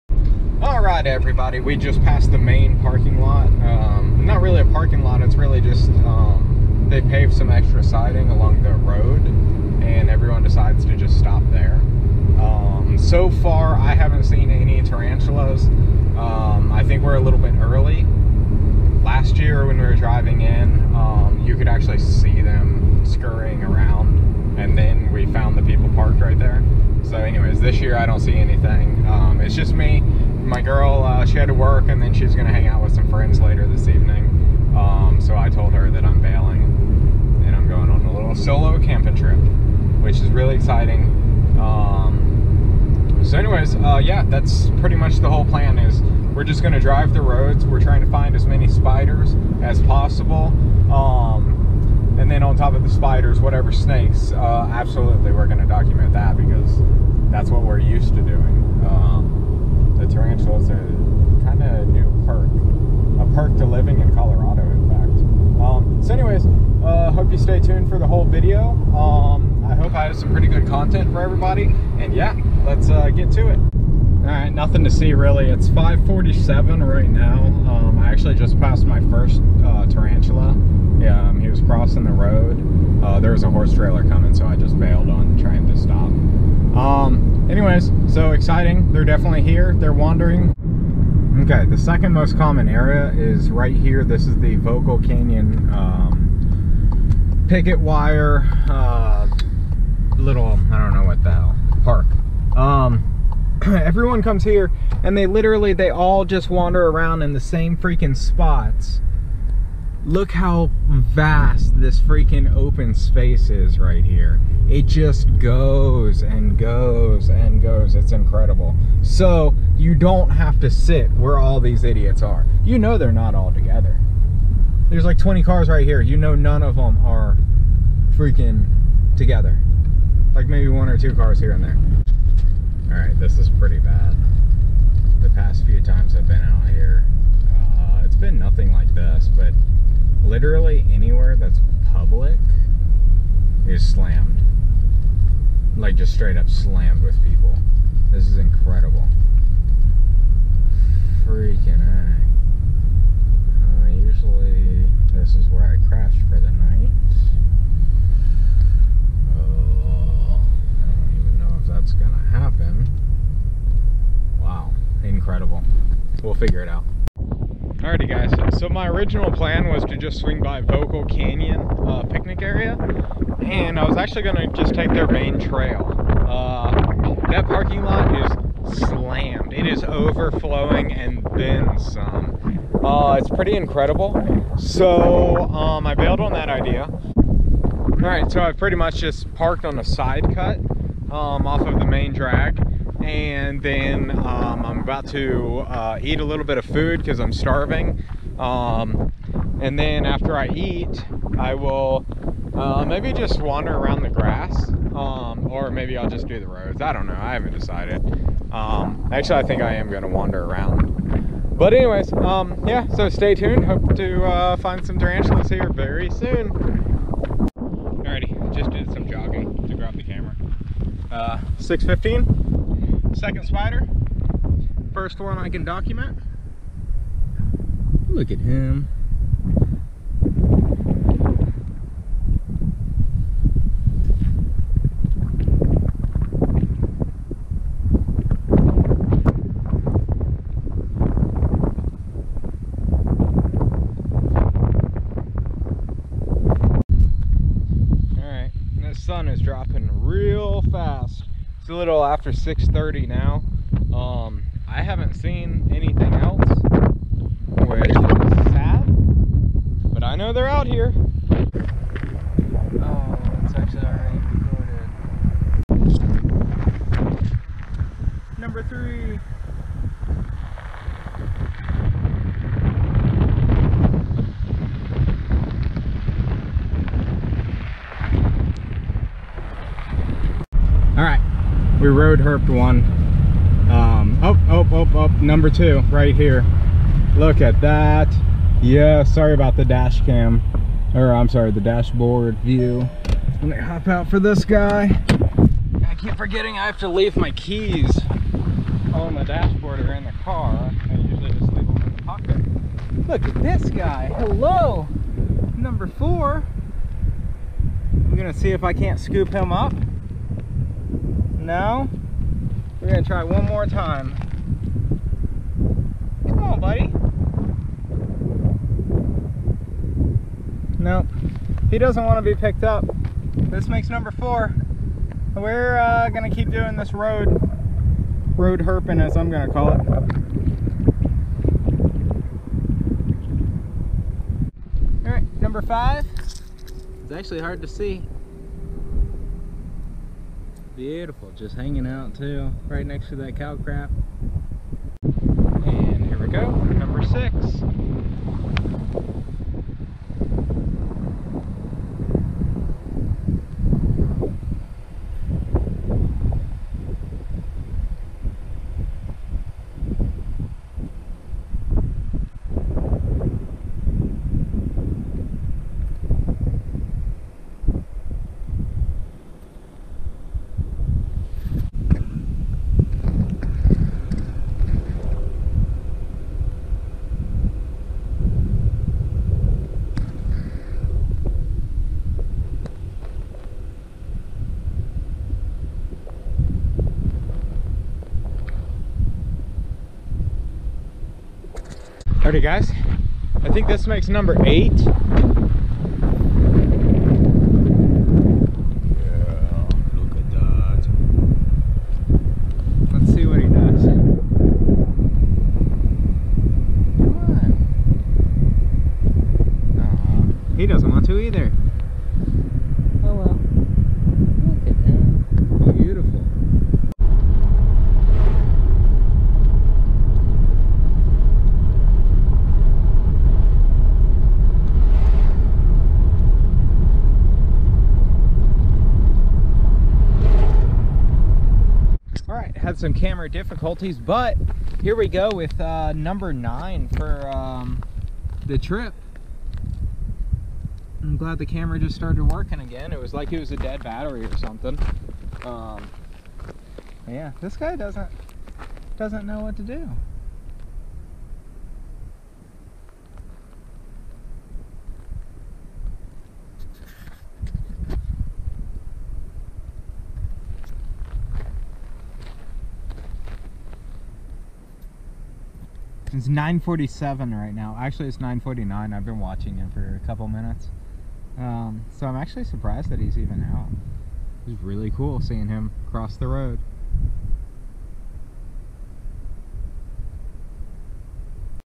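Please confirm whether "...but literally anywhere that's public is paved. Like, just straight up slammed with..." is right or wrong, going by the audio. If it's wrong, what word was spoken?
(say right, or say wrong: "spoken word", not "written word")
wrong: "slammed", not "paved".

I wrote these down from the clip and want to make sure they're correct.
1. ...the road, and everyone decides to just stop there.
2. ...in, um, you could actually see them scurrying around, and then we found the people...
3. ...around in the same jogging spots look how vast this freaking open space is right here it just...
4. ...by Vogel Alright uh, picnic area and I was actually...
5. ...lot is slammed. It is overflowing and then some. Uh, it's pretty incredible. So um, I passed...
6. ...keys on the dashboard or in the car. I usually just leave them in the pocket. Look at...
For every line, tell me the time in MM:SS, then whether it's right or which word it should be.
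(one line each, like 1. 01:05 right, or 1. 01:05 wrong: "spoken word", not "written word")
1. 00:08 right
2. 00:20 right
3. 01:46 wrong: "freaking", not "jogging"
4. 02:50 wrong: "Canyon", not "Alright"
5. 02:57 wrong: "bailed", not "passed"
6. 04:57 right.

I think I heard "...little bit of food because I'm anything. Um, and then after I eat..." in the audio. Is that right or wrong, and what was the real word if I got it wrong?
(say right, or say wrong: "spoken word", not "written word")
wrong: "starving", not "anything".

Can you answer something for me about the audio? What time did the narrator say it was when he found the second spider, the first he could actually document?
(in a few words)
6:15.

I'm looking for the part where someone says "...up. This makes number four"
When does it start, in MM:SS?
05:22.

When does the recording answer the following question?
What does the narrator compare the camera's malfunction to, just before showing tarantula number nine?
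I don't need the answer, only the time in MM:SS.
07:23.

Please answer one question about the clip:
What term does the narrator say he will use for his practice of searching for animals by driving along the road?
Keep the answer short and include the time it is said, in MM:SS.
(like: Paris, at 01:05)
road herping, at 05:28.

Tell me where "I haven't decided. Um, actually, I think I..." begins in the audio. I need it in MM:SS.
03:27.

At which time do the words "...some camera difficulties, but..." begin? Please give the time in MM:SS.
07:12.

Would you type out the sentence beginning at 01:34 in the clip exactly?
This is the Vogel Canyon um, Picketwire uh, little, I don't know what the hell, park.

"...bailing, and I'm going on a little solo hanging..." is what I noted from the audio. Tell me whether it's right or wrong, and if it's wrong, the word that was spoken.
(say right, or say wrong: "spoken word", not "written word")
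wrong: "camping", not "hanging".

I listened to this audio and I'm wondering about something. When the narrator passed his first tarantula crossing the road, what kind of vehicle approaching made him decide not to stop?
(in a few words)
horse trailer.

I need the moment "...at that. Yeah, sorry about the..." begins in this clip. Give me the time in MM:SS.
04:47.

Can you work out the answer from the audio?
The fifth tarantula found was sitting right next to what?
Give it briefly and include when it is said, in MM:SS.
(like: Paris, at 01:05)
cow crap, at 05:43.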